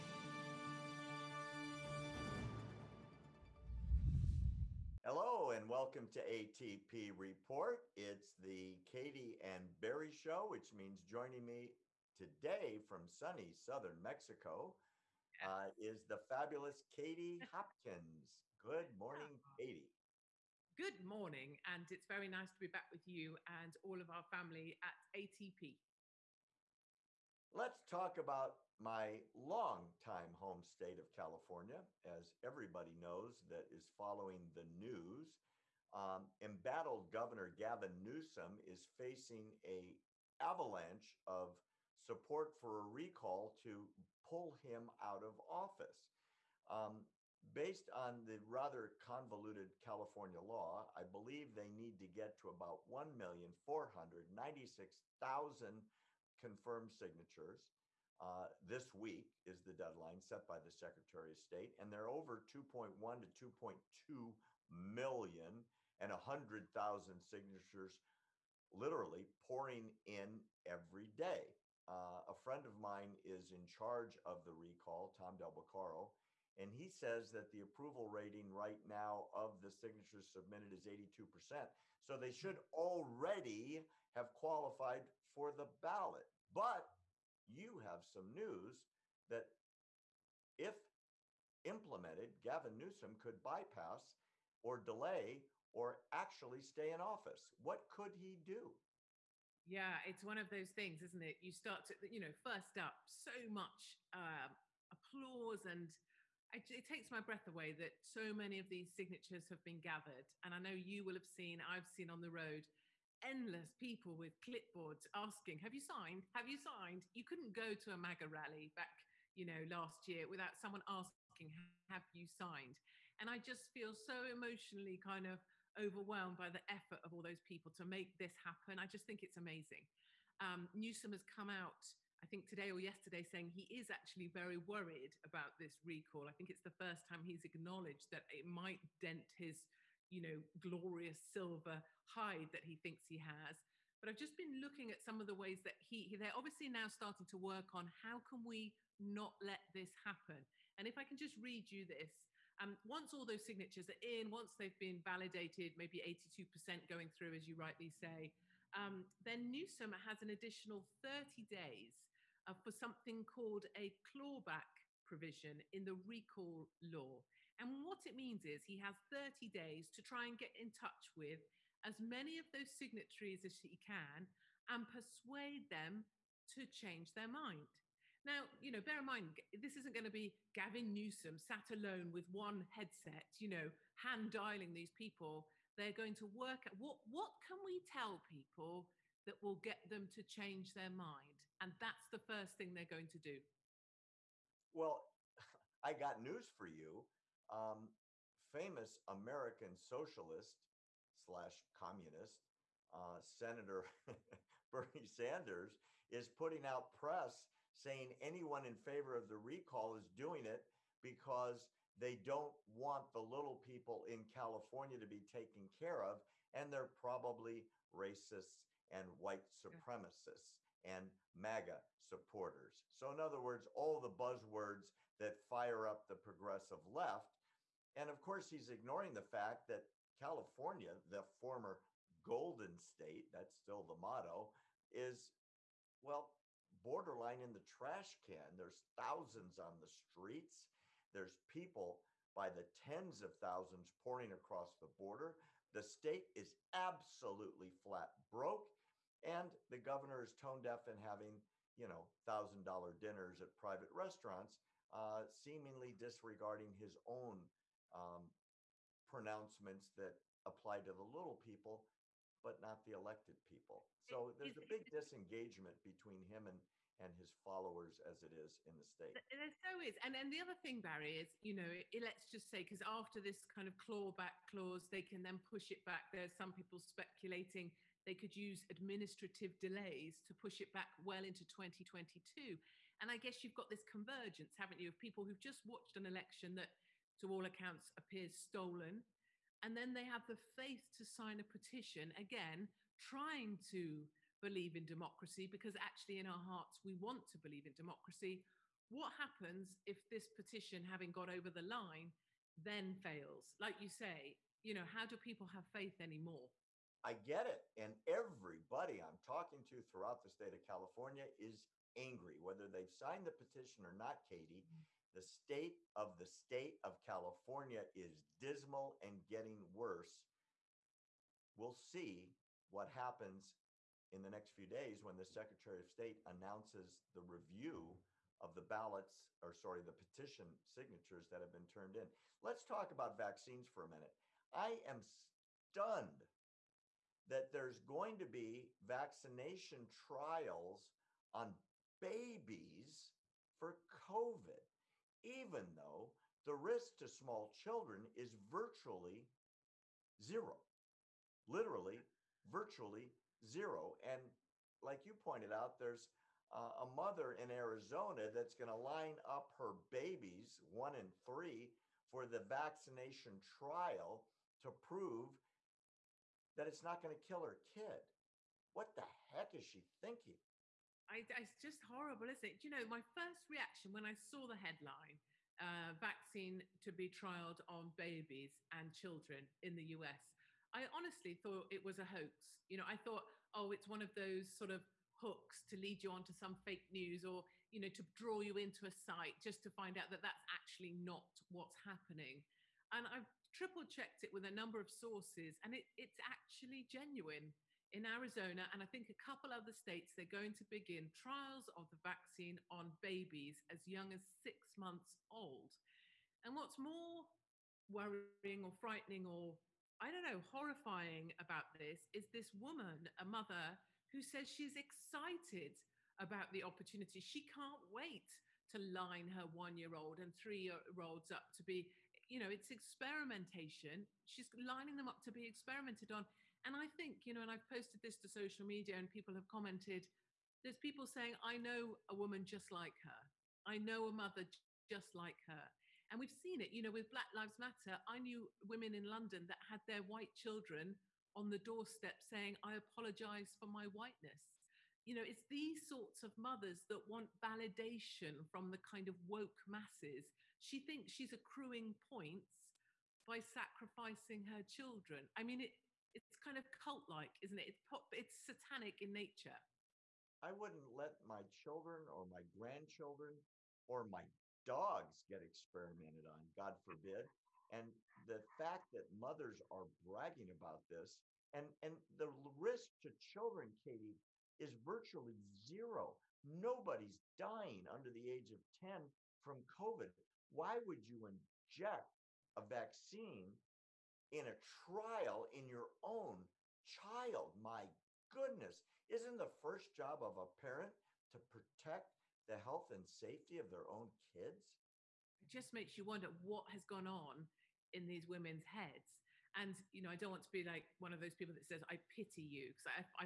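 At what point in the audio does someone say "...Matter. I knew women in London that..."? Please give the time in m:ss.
7:17.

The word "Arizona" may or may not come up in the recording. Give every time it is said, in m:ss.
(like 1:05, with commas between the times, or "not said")
5:57, 6:38.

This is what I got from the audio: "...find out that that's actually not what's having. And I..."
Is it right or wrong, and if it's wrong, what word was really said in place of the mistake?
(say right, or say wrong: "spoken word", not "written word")
wrong: "happening", not "having".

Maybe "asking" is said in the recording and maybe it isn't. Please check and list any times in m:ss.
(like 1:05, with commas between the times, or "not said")
1:55, 2:00.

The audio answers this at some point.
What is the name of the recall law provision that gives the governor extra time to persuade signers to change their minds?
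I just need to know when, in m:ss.
2:44.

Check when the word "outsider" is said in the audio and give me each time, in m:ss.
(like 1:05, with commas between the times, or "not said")
not said.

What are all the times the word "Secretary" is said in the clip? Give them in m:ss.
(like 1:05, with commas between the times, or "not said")
1:00, 5:25.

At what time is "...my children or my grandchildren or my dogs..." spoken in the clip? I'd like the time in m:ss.
7:41.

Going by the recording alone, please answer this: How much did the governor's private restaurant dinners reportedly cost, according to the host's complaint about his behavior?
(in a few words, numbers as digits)
$1,000.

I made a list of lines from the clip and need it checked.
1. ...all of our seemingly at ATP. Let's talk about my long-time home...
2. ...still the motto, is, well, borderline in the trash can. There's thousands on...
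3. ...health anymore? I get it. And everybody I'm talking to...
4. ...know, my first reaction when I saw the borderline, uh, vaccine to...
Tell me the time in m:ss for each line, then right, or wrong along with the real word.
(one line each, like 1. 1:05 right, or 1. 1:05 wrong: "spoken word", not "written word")
1. 0:23 wrong: "family", not "seemingly"
2. 3:53 right
3. 5:05 wrong: "faith", not "health"
4. 6:12 wrong: "headline", not "borderline".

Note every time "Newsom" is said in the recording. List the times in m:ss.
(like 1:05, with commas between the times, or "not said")
0:38, 1:32, 2:10, 2:39, 3:00.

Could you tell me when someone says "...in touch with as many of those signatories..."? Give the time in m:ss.
2:50.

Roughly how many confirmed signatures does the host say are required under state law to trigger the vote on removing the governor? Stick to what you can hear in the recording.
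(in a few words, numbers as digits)
1,496,000.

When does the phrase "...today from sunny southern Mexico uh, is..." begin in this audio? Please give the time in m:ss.
0:12.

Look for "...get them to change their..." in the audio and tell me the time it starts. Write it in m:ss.
3:09.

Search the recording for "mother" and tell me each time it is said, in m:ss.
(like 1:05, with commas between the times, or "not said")
5:56, 6:53, 7:14, 7:26, 7:49.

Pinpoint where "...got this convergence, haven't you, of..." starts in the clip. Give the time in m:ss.
4:43.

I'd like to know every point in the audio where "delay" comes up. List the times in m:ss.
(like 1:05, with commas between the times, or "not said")
1:34, 4:39.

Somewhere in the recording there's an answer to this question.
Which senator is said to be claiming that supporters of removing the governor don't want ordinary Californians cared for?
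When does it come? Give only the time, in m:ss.
3:24.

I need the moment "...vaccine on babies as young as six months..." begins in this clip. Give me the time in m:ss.
6:42.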